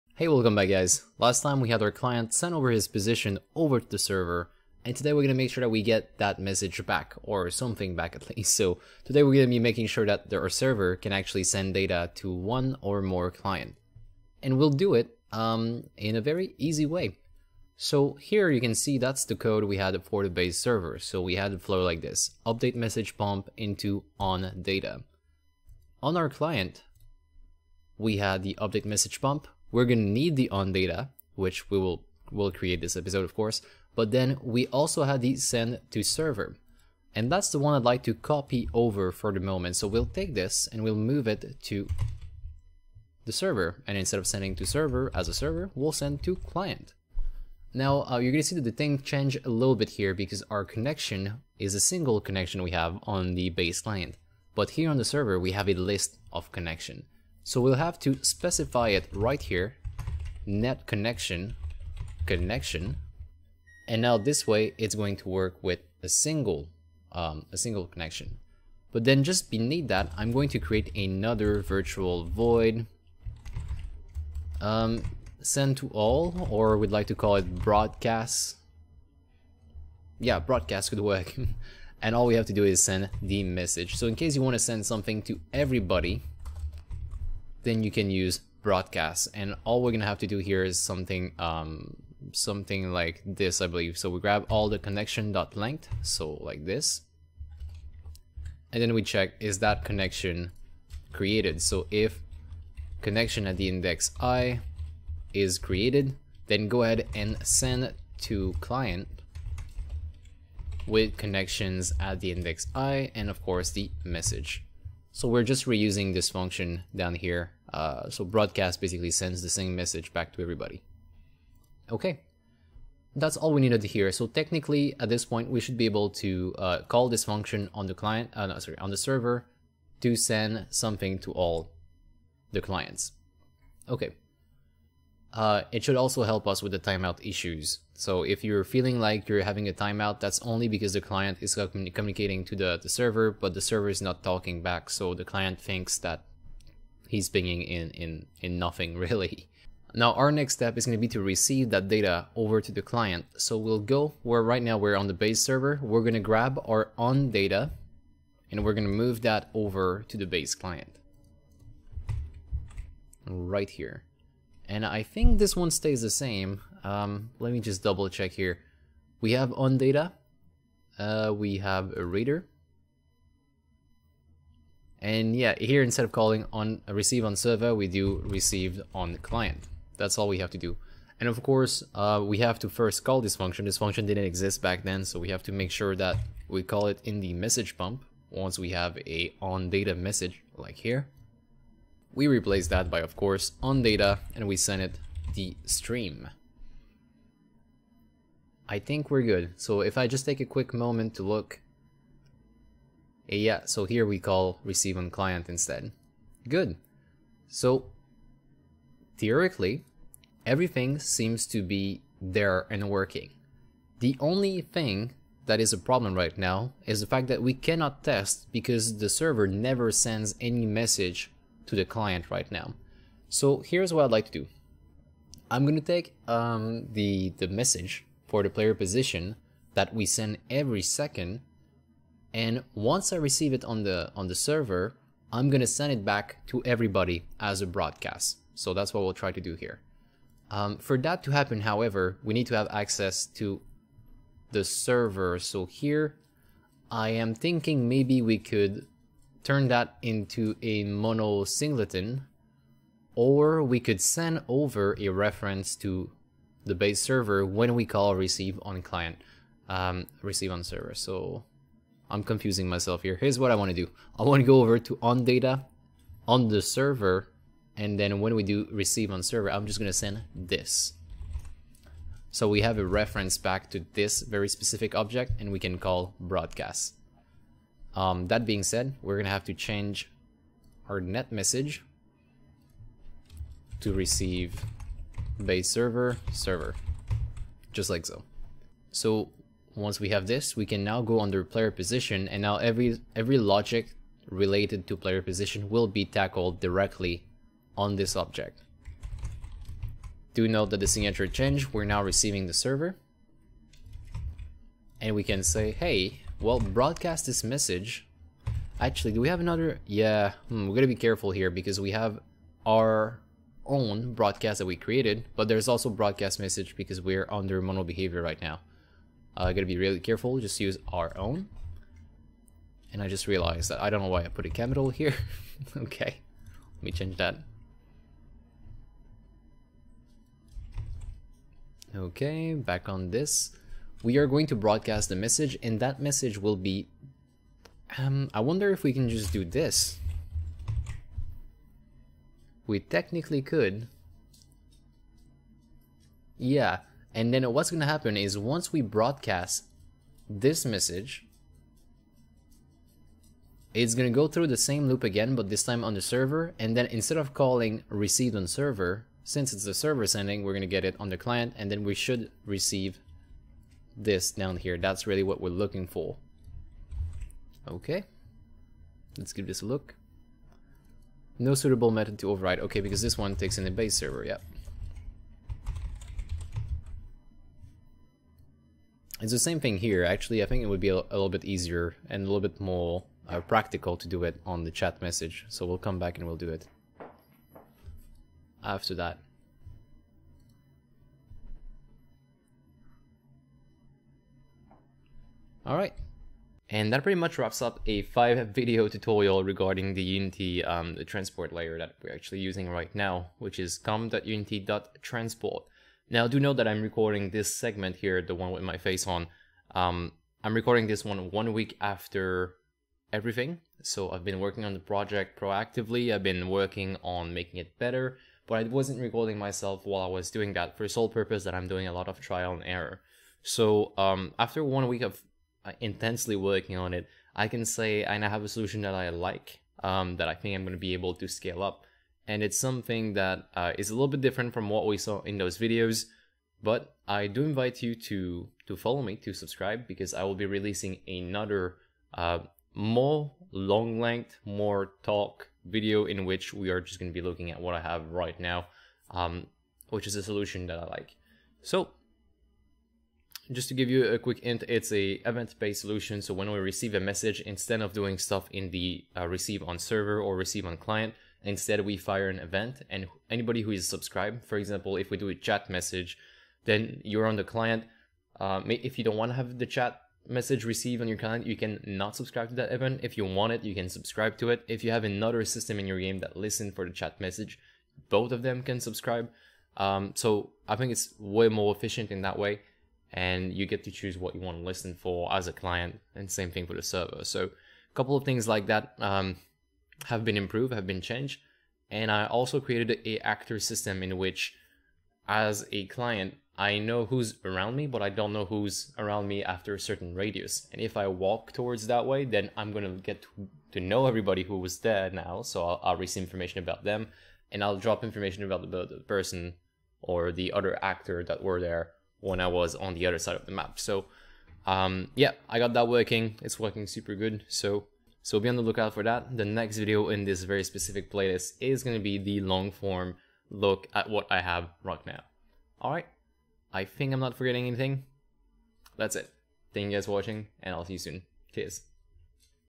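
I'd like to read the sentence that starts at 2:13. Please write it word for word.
Okay, uh, it should also help us with the timeout issues.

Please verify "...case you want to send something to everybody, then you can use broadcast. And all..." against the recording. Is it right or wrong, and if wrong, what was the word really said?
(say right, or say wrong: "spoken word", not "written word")
right.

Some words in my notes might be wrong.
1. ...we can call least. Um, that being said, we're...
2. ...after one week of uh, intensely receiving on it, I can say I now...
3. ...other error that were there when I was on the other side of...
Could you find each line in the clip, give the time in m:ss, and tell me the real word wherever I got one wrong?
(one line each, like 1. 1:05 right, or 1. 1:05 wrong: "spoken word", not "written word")
1. 4:35 wrong: "broadcast", not "least"
2. 7:04 wrong: "working", not "receiving"
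3. 8:30 wrong: "actor", not "error".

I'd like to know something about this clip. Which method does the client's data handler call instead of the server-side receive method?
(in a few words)
received on client.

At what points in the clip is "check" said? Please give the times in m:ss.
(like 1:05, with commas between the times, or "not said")
1:39, 2:48.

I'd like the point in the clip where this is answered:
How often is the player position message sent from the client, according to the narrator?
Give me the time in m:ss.
3:50.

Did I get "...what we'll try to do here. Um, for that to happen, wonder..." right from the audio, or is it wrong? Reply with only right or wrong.
wrong.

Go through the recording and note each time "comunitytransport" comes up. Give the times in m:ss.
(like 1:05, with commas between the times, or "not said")
6:43.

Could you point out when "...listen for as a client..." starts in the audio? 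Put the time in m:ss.
8:04.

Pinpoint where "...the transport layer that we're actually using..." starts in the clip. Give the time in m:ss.
6:40.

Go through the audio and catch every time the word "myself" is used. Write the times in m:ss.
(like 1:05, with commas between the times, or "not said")
4:22, 6:59.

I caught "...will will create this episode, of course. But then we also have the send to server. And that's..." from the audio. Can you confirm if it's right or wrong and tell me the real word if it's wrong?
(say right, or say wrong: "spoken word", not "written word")
right.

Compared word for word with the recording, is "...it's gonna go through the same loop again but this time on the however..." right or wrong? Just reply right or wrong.
wrong.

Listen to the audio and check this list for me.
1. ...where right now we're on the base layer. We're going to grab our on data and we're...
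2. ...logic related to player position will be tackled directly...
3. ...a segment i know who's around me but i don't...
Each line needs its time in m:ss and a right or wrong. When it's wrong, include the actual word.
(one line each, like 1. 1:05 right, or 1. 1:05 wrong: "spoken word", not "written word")
1. 2:34 wrong: "server", not "layer"
2. 4:53 right
3. 8:15 wrong: "client", not "segment".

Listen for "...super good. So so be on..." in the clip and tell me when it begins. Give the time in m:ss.
8:36.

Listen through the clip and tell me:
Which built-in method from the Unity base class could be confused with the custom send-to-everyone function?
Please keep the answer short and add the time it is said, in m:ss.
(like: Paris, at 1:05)
broadcast message, at 5:15.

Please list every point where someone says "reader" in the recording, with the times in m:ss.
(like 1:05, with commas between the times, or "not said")
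2:52.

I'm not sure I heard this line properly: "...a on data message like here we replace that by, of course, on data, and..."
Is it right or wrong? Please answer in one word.
right.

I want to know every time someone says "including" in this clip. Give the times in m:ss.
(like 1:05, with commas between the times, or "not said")
not said.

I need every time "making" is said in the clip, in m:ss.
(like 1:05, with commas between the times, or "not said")
0:09, 6:57.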